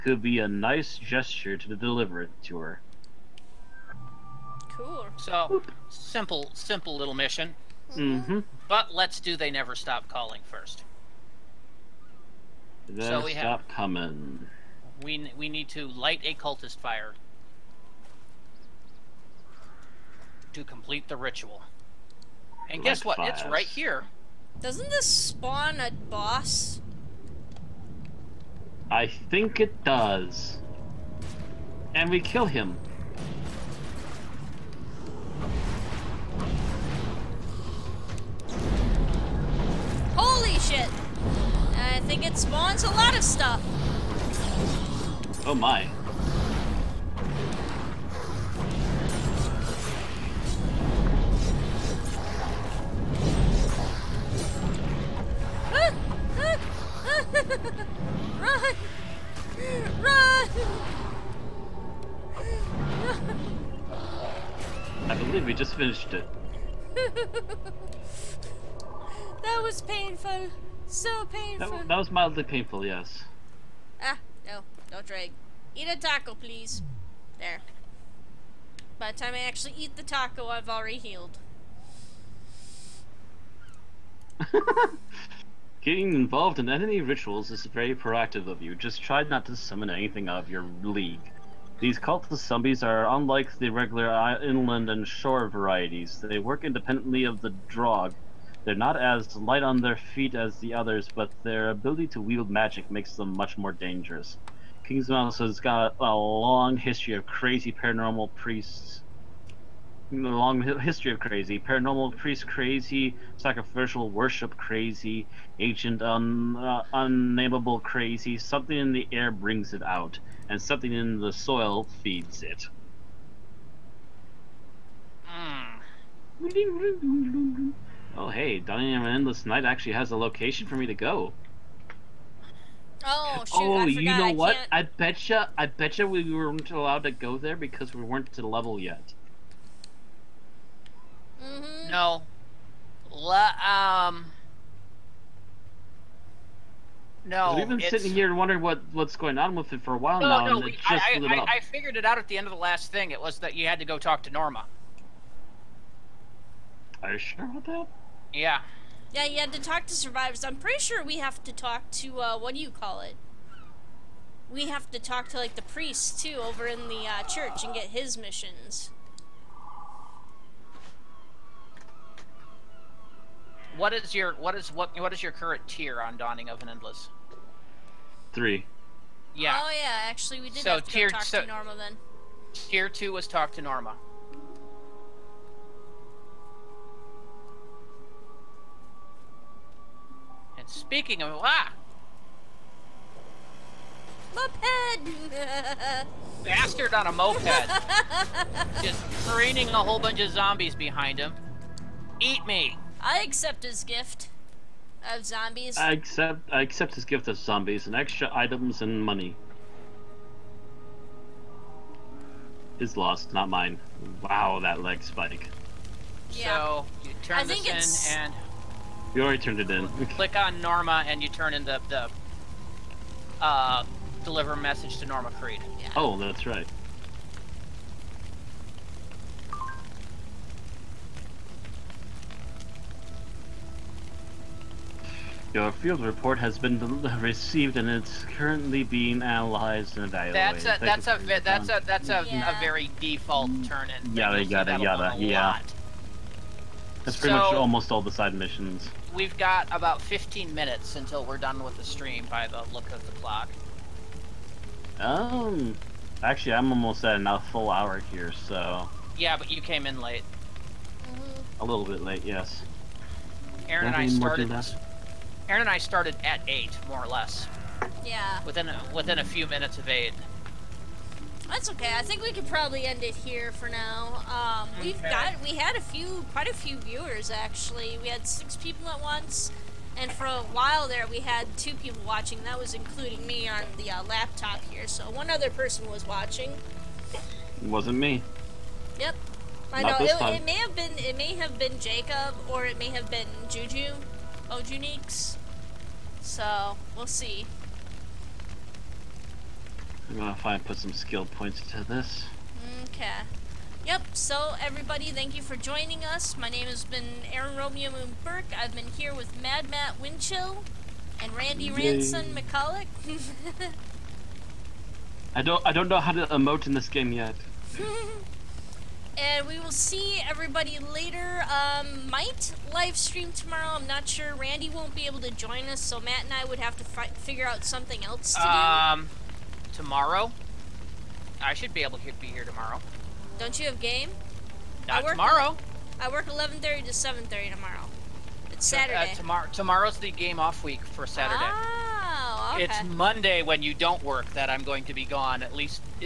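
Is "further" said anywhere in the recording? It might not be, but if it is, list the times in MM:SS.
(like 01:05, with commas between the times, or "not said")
not said.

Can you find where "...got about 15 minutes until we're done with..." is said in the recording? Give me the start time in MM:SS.
04:09.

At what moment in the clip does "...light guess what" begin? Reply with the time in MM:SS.
00:22.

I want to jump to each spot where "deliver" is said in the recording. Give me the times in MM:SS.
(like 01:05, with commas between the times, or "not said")
00:01, 03:44.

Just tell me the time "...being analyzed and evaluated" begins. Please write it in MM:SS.
03:58.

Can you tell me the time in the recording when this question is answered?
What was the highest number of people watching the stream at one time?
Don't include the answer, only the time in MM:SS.
04:38.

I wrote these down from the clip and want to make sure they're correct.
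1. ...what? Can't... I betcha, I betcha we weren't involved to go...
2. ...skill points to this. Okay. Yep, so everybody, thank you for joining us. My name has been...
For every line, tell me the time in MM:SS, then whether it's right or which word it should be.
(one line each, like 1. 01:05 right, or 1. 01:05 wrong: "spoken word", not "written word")
1. 02:14 wrong: "allowed", not "involved"
2. 05:00 right.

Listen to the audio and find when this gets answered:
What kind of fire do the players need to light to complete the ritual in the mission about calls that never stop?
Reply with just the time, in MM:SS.
00:16.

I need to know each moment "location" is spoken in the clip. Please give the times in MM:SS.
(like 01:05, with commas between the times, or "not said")
02:10.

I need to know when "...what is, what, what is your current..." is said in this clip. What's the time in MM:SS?
02:54.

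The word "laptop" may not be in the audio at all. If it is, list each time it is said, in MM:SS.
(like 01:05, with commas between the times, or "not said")
04:44.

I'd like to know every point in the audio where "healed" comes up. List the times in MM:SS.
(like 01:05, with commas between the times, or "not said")
01:20.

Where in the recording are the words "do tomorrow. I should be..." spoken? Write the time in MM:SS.
05:29.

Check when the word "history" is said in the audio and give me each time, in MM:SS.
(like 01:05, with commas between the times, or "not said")
01:46, 01:50.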